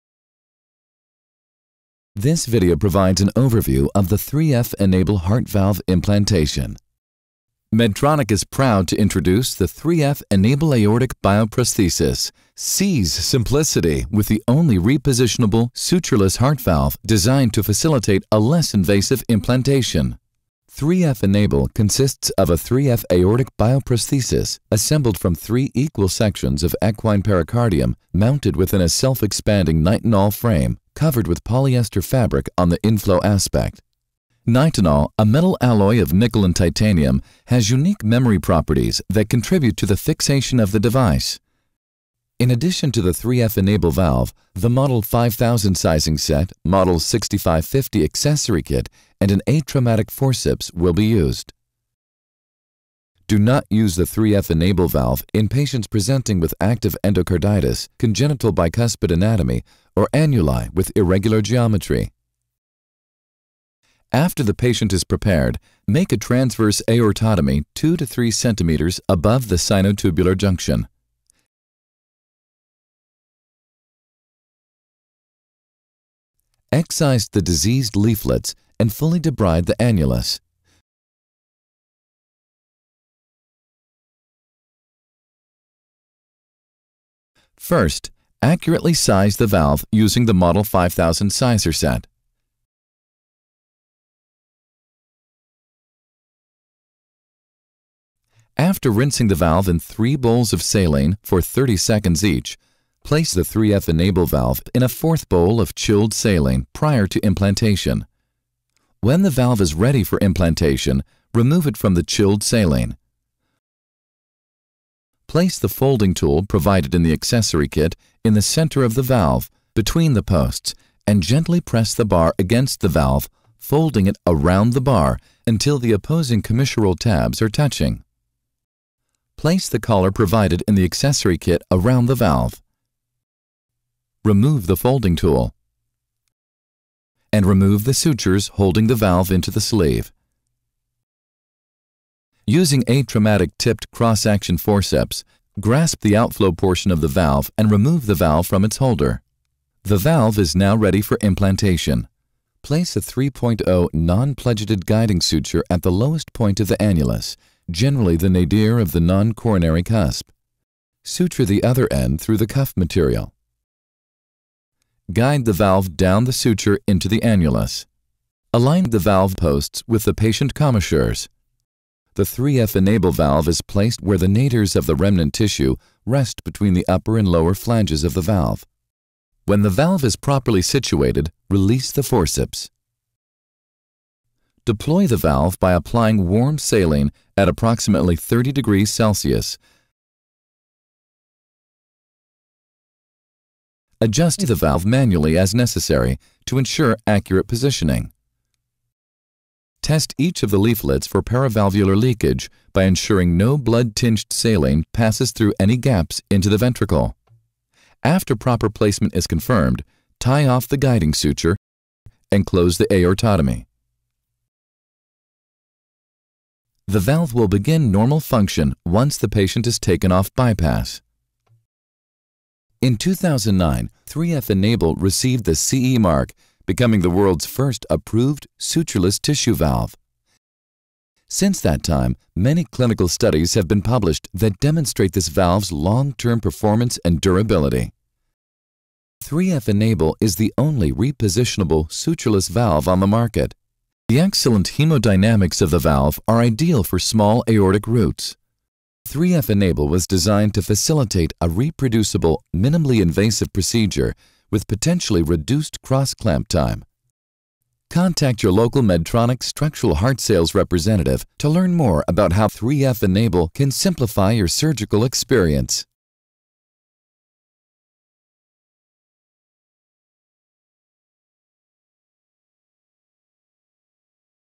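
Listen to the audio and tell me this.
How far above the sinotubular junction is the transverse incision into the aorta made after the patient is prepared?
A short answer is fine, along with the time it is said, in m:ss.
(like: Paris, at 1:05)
2 to 3 centimeters, at 1:07.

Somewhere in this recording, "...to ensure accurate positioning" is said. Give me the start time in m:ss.
3:16.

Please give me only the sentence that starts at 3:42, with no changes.
In 2009, 3F Enable received the CE mark becoming the world's first approved sutureless tissue valve.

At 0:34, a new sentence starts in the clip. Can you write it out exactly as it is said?
Nitinol, a metal alloy of nickel and titanium, has unique memory properties that contribute to the fixation of the device.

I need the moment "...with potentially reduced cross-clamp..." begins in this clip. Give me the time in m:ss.
4:14.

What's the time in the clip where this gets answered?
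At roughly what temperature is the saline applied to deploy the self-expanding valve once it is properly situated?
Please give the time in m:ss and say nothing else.
3:08.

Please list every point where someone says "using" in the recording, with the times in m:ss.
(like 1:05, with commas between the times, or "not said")
1:29, 2:22.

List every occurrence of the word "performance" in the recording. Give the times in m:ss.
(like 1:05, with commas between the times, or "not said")
3:56.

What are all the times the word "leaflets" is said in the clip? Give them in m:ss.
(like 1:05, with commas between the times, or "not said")
1:17, 3:20.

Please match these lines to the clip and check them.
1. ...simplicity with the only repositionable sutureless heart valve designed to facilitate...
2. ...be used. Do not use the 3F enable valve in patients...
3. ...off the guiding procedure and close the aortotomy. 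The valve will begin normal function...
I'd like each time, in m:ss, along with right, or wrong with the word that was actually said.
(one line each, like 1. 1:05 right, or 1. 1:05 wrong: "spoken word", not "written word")
1. 0:13 right
2. 0:50 right
3. 3:30 wrong: "suture", not "procedure".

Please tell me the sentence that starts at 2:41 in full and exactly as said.
Suture the other end through the cuff material.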